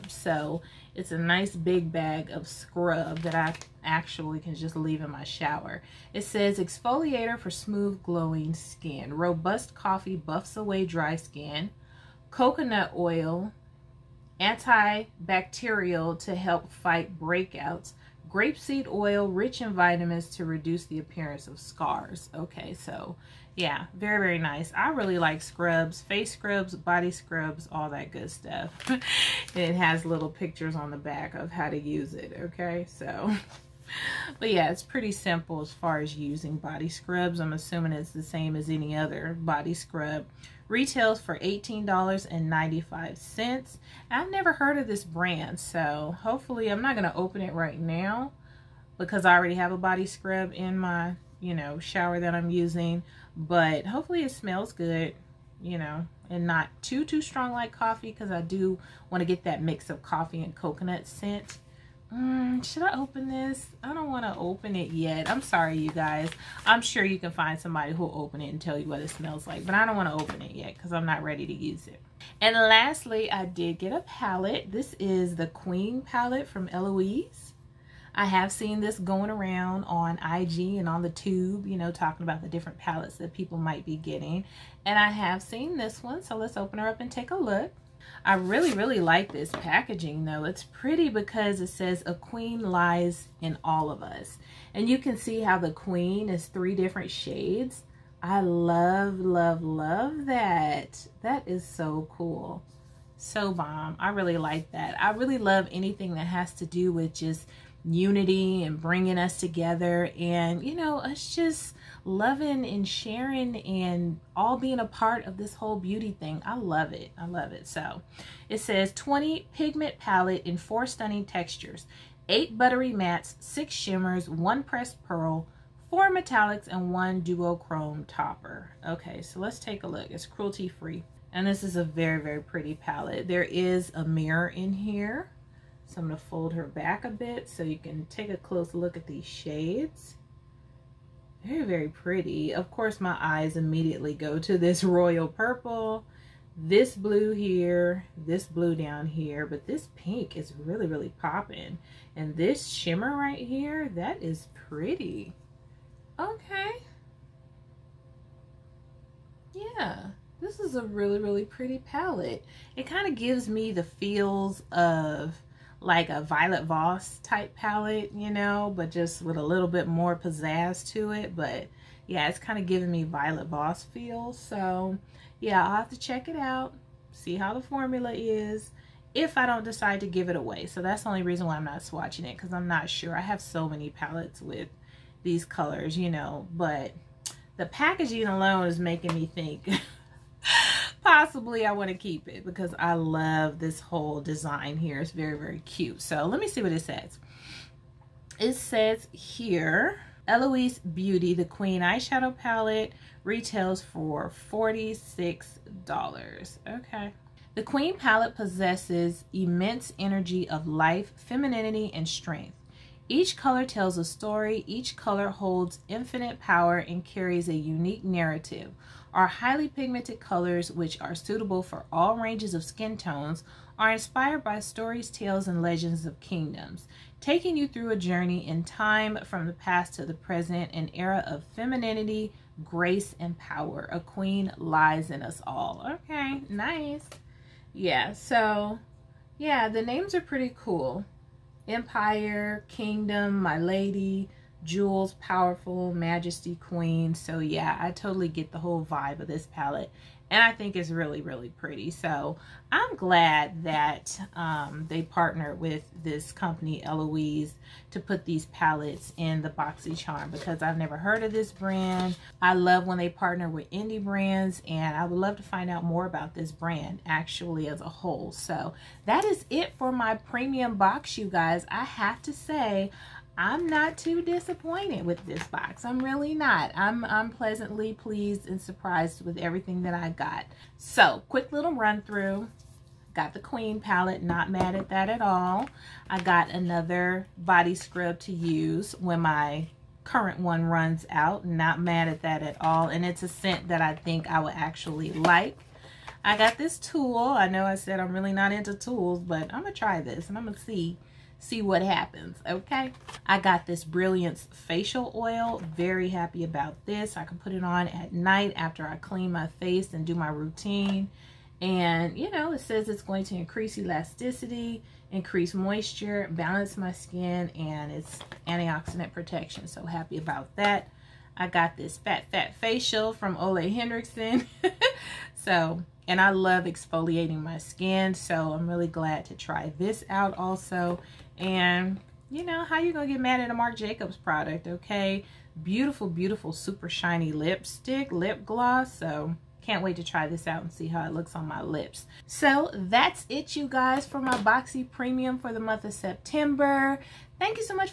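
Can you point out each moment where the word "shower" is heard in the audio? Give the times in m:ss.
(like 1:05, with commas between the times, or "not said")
0:05, 0:51.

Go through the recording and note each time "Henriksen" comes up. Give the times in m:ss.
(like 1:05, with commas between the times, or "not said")
5:23.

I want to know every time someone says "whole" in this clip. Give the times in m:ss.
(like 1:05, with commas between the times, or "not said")
1:55, 3:13, 4:08, 4:27.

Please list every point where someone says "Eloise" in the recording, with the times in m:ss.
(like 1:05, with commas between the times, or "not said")
1:16, 3:20, 4:16.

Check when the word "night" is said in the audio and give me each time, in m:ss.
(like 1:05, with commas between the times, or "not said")
5:08.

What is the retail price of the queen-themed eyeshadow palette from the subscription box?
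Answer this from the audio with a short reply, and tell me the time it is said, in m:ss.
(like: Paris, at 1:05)
$46, at 3:24.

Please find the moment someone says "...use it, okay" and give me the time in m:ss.
0:31.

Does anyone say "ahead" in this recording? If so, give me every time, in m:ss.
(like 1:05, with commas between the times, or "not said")
not said.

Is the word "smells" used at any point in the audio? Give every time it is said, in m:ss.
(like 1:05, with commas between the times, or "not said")
0:54, 1:09.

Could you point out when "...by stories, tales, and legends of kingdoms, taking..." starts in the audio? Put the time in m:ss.
3:44.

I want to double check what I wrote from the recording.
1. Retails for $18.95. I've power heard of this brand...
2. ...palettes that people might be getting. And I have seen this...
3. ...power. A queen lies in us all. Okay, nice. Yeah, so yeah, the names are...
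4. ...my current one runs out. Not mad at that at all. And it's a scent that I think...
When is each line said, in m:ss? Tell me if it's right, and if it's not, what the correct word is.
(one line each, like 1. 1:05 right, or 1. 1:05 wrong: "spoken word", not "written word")
1. 0:40 wrong: "never", not "power"
2. 1:22 right
3. 3:53 right
4. 4:49 right.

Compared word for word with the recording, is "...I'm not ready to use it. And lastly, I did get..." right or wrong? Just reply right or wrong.
right.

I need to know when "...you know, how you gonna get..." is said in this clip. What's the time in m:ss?
5:32.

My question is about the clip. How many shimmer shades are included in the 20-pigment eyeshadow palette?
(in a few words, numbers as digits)
6.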